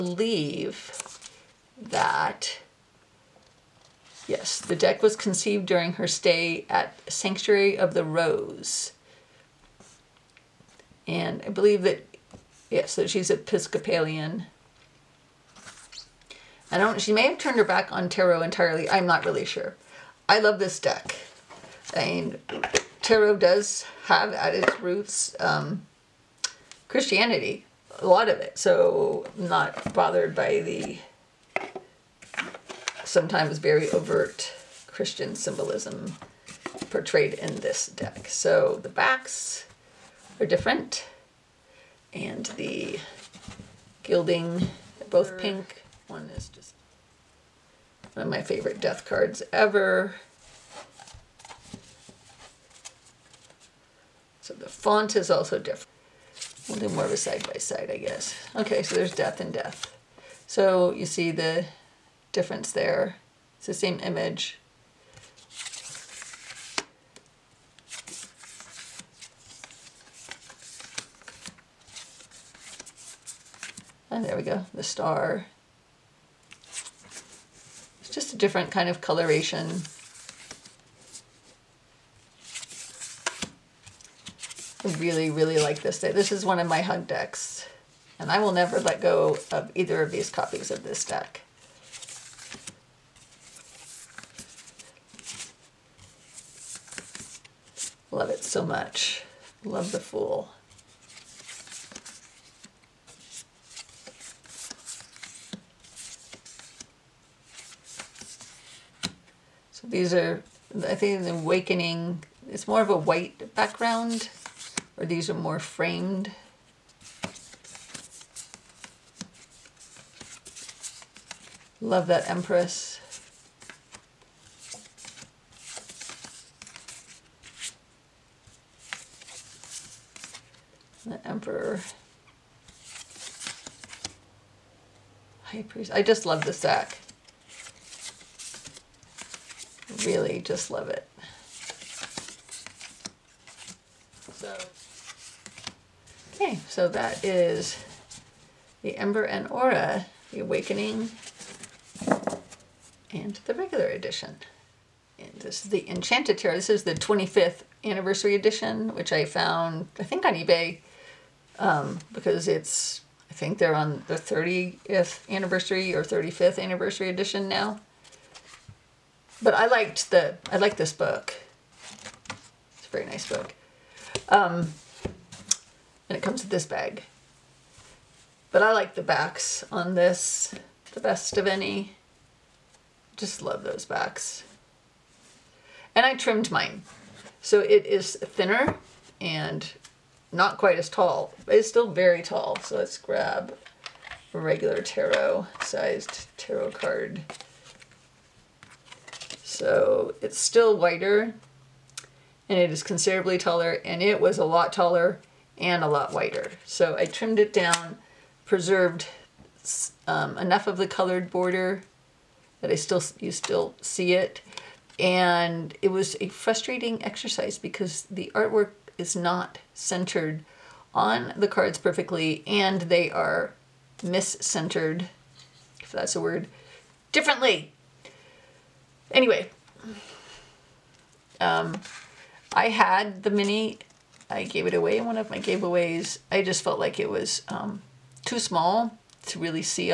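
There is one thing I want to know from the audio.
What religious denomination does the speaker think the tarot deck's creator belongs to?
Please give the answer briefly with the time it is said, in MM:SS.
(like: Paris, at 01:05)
Episcopalian, at 00:13.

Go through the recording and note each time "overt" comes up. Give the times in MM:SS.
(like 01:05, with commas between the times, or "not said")
00:33.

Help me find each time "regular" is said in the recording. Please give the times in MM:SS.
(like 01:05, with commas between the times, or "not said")
02:33, 03:14.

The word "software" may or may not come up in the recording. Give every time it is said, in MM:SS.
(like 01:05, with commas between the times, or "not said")
not said.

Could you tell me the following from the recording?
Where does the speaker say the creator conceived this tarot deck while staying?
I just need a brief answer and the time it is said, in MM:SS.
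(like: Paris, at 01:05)
Sanctuary of the Rose, at 00:07.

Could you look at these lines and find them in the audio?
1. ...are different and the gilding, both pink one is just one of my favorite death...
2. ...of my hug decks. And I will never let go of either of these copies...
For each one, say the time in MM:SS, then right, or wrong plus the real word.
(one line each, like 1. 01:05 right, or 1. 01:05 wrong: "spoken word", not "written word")
1. 00:40 right
2. 01:26 right.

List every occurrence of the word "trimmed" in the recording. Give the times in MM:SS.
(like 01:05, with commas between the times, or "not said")
03:06, 03:27.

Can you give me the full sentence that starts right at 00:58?
Okay, so there's death and death.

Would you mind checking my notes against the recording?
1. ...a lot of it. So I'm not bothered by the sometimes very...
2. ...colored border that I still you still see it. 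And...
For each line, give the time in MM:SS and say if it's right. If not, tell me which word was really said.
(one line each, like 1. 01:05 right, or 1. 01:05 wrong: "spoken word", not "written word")
1. 00:27 right
2. 03:30 right.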